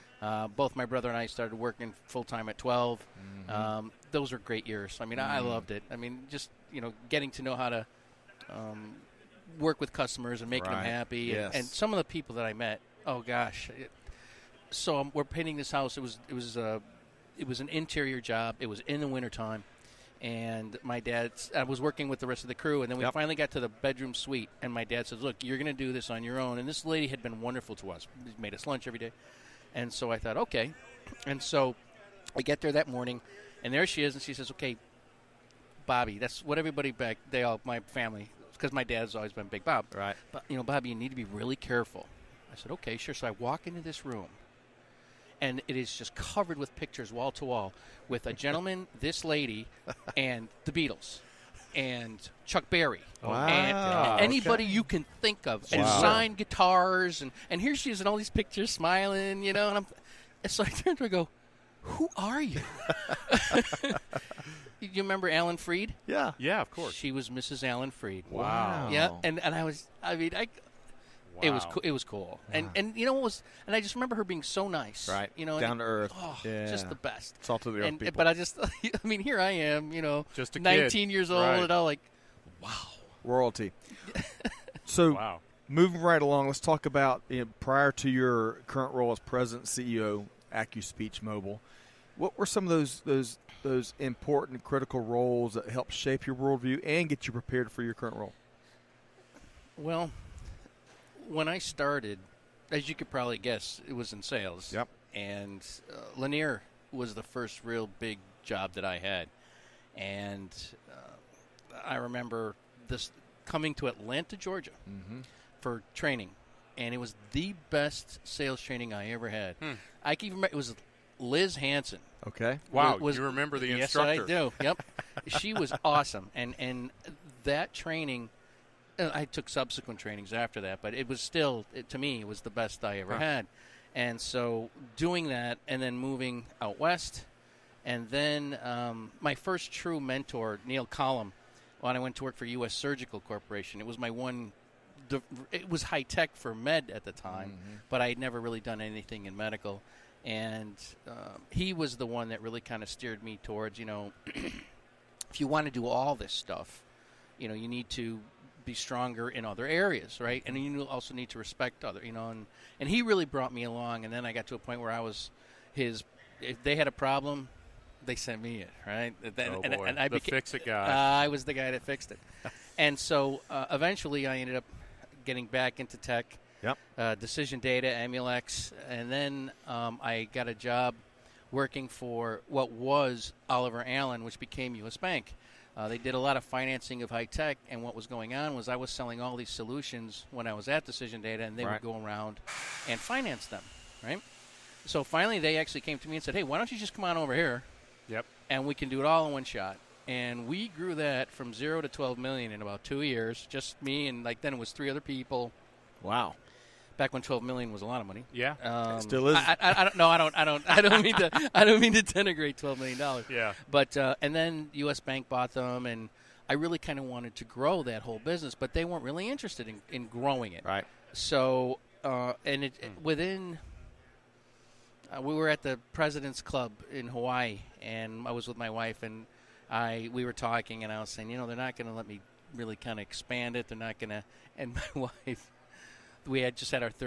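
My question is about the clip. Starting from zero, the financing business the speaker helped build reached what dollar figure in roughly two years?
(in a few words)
12 million.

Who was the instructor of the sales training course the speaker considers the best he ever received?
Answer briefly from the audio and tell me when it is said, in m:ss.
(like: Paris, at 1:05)
Liz Hanson, at 2:01.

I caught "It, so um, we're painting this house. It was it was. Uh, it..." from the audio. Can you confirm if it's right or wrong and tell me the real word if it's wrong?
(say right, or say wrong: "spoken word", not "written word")
right.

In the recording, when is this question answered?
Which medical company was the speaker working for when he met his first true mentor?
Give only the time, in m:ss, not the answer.
2:22.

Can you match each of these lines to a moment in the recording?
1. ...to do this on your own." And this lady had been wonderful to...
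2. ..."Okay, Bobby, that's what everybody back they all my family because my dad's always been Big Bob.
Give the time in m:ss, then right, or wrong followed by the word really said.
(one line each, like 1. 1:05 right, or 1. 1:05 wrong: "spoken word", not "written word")
1. 0:25 right
2. 0:34 right.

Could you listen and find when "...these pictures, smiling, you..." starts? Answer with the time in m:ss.
0:58.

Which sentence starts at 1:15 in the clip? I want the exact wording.
You know, down to earth, oh, yeah.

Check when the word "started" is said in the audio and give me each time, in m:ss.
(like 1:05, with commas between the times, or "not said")
0:01, 1:41.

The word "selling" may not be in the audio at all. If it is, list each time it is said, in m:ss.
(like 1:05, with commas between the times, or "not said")
3:08.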